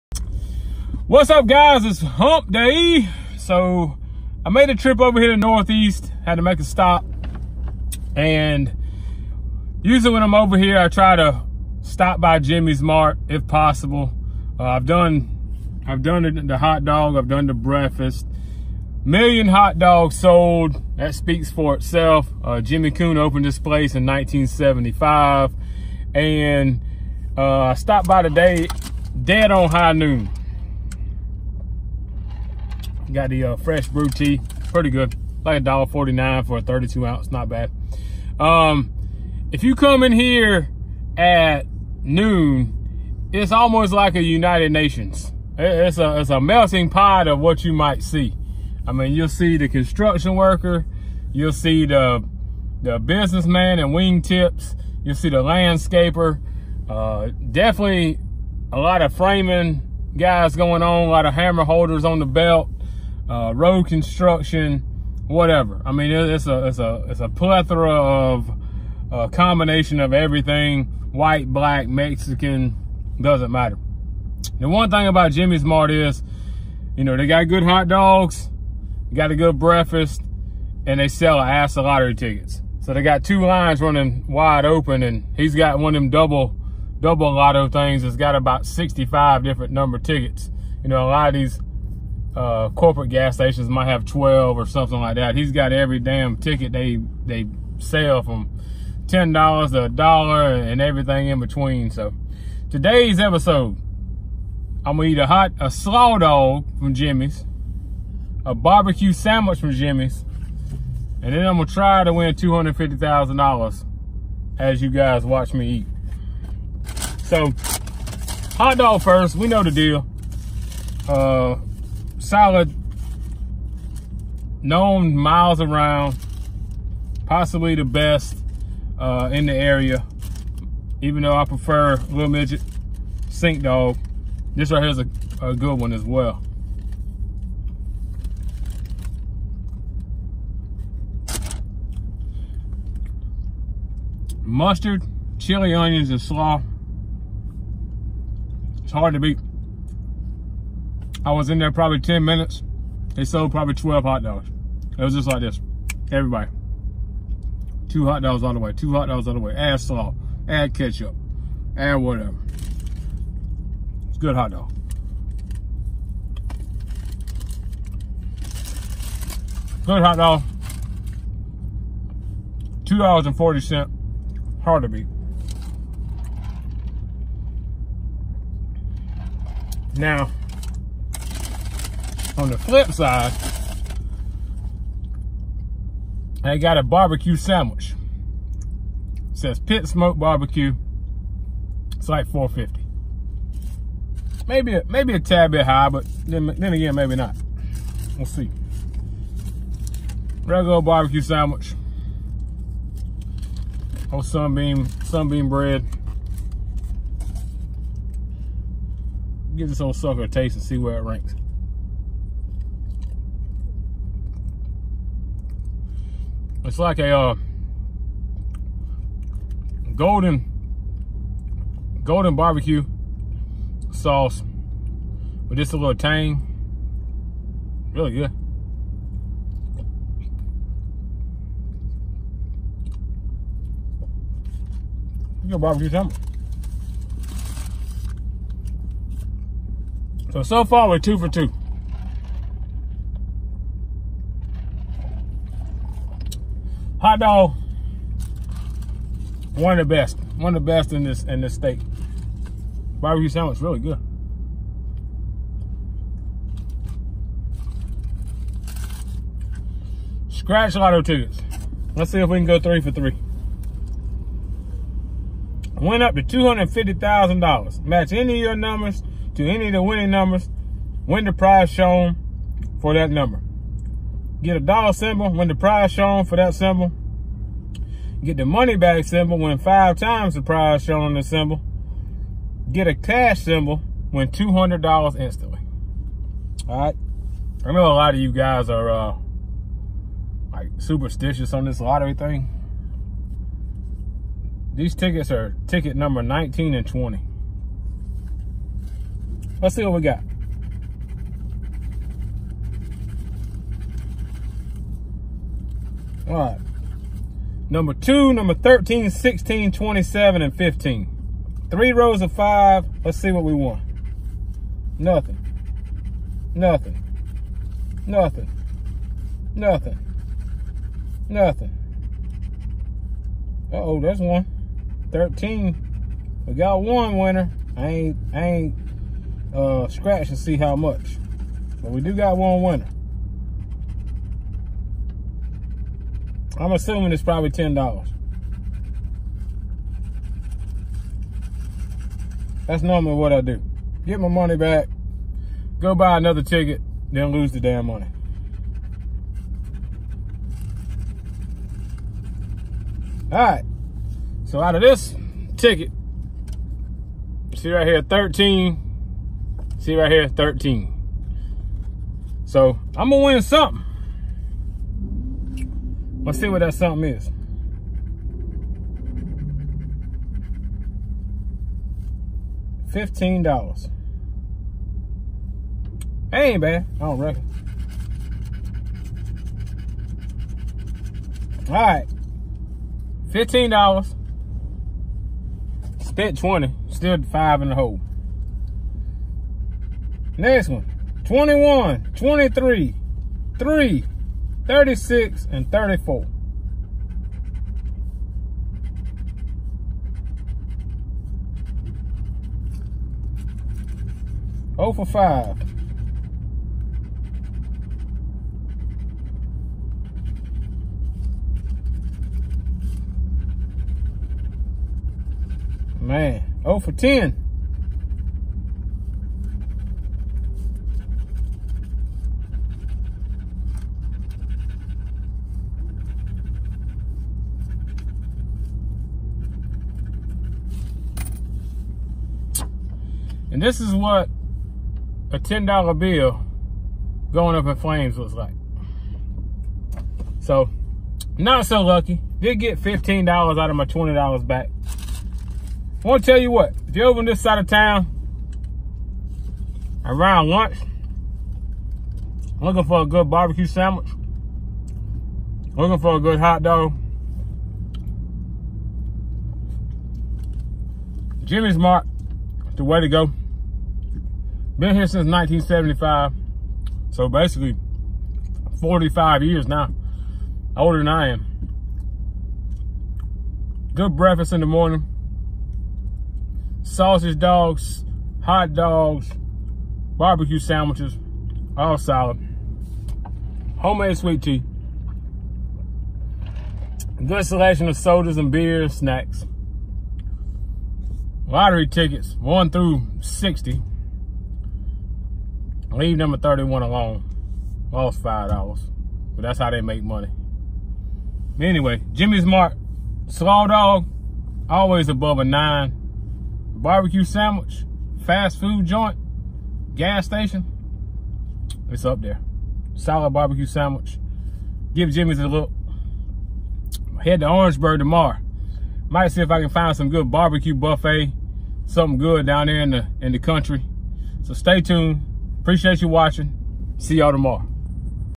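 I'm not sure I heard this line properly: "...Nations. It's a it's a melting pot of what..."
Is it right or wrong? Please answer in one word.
right.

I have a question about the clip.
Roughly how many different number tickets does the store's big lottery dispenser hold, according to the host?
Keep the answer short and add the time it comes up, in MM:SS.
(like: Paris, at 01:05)
65, at 01:28.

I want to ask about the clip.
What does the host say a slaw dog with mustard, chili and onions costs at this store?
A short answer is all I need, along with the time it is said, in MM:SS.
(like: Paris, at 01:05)
$2.40, at 02:52.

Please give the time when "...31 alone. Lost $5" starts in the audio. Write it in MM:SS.
08:16.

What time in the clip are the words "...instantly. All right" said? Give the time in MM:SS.
04:45.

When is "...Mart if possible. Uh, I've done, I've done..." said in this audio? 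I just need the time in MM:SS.
00:12.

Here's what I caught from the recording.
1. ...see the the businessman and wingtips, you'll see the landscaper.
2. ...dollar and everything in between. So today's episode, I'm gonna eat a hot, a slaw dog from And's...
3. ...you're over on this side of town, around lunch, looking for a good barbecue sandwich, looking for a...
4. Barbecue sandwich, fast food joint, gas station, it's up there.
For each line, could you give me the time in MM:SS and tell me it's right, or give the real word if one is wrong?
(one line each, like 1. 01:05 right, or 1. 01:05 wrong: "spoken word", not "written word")
1. 00:51 right
2. 01:39 wrong: "Jimmy", not "And"
3. 07:26 right
4. 08:26 right.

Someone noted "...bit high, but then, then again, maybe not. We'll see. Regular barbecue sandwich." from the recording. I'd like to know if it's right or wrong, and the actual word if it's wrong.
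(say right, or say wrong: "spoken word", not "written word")
right.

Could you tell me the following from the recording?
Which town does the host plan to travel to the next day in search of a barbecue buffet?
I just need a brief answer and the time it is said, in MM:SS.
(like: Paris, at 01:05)
Orangeburg, at 08:37.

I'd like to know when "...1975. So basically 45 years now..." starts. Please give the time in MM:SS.
07:45.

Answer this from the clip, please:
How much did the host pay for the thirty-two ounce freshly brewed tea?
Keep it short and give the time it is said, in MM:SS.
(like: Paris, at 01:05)
$1.49, at 00:35.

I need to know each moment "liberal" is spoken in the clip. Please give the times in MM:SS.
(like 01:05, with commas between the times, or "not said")
not said.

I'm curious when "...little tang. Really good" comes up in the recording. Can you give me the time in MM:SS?
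03:45.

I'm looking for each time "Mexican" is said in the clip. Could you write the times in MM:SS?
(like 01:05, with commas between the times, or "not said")
01:11.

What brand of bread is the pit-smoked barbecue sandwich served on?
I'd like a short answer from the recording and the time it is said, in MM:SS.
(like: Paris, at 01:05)
Sunbeam, at 03:25.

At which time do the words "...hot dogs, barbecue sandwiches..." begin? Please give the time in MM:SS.
07:58.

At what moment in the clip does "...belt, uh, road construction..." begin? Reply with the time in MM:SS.
01:02.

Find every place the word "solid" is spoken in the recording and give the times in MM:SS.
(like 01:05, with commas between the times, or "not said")
02:02, 08:01, 08:32.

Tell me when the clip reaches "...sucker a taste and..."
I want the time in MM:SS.
03:29.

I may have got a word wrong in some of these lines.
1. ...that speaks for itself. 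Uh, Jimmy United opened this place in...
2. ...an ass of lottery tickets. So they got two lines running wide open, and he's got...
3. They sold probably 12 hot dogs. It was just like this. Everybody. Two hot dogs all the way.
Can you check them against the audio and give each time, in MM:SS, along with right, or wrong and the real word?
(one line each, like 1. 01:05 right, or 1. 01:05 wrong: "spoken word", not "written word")
1. 00:20 wrong: "Coon", not "United"
2. 01:21 right
3. 02:33 right.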